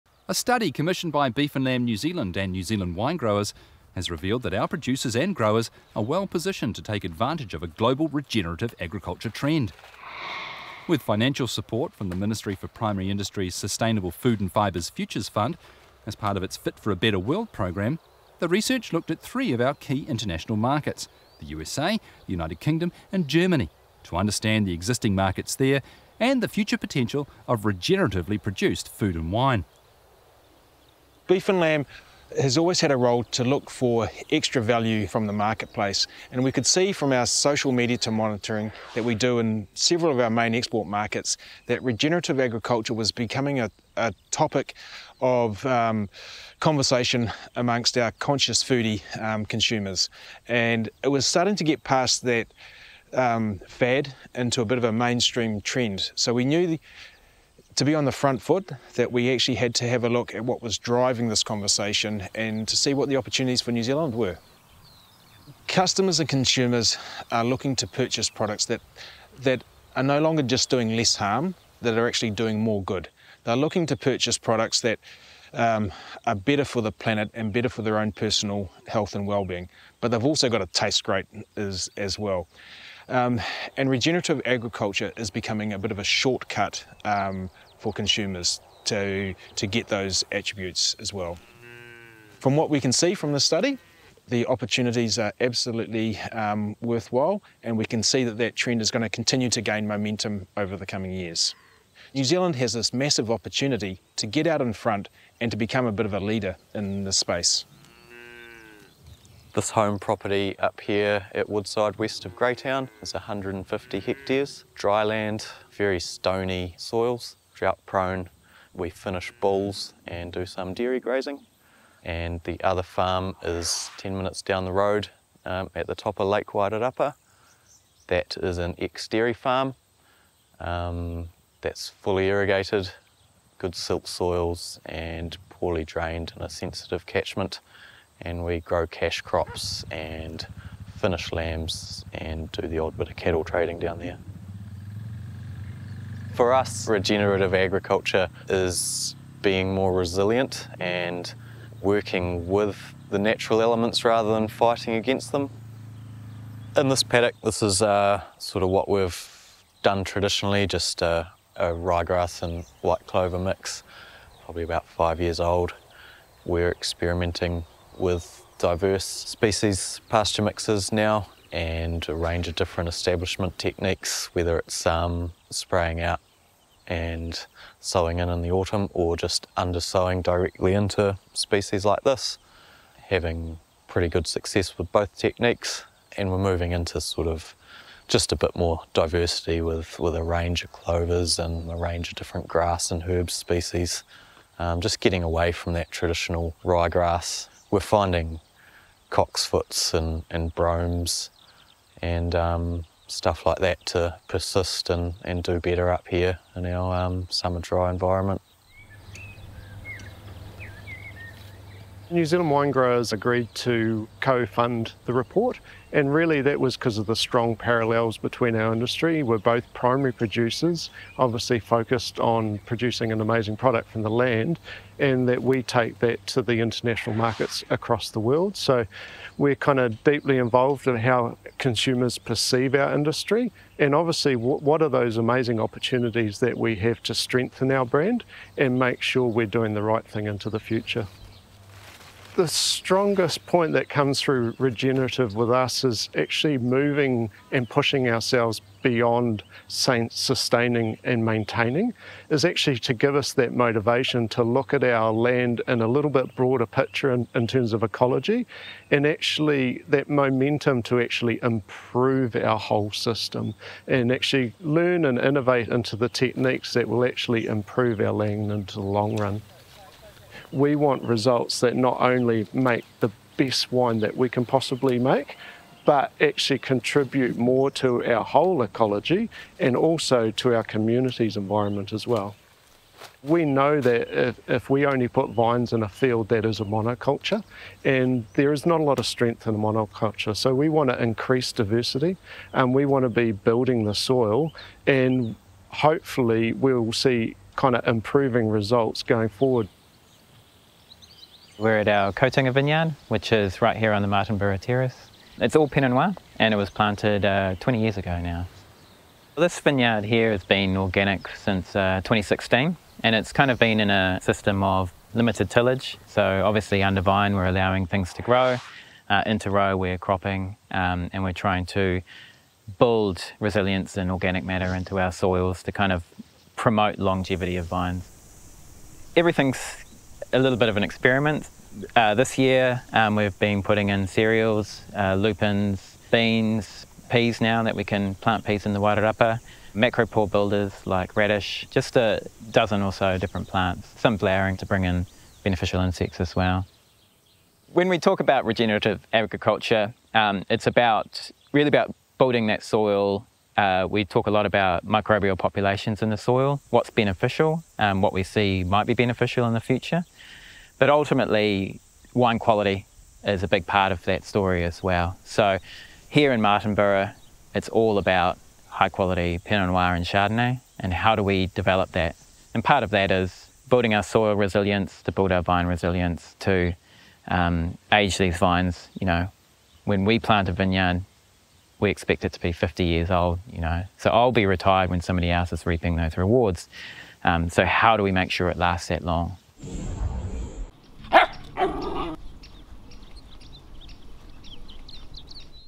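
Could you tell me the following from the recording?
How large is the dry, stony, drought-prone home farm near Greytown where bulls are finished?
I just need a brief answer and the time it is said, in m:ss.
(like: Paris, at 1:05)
150 hectares, at 1:53.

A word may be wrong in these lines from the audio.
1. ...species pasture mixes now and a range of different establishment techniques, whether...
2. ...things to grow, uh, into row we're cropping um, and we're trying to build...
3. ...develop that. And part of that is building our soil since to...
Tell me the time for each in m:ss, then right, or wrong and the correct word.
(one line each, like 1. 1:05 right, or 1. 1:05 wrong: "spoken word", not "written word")
1. 2:49 right
2. 5:17 right
3. 6:11 wrong: "resilience", not "since".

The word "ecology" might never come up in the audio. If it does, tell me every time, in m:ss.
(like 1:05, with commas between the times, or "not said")
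4:17, 4:38.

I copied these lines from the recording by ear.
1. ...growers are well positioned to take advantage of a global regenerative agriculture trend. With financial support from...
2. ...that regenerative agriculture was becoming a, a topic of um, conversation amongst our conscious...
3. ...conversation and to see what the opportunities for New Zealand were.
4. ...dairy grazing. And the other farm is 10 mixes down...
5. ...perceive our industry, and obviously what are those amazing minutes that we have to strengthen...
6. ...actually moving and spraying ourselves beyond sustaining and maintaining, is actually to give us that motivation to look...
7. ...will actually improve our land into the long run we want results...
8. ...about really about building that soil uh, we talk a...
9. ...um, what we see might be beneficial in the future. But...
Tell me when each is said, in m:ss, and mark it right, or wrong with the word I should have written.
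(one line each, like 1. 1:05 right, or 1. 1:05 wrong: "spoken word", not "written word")
1. 0:05 right
2. 0:41 right
3. 1:01 right
4. 2:00 wrong: "minutes", not "mixes"
5. 3:52 wrong: "opportunities", not "minutes"
6. 4:06 wrong: "pushing", not "spraying"
7. 4:26 right
8. 5:50 right
9. 5:57 right.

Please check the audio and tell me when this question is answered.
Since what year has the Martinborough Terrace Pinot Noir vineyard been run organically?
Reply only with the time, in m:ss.
5:12.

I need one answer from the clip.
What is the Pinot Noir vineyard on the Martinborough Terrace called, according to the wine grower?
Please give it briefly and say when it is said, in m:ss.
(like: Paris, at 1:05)
Kotunga, at 5:02.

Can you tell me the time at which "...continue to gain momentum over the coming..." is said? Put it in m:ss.
1:39.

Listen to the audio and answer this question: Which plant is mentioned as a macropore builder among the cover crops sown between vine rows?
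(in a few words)
Radish.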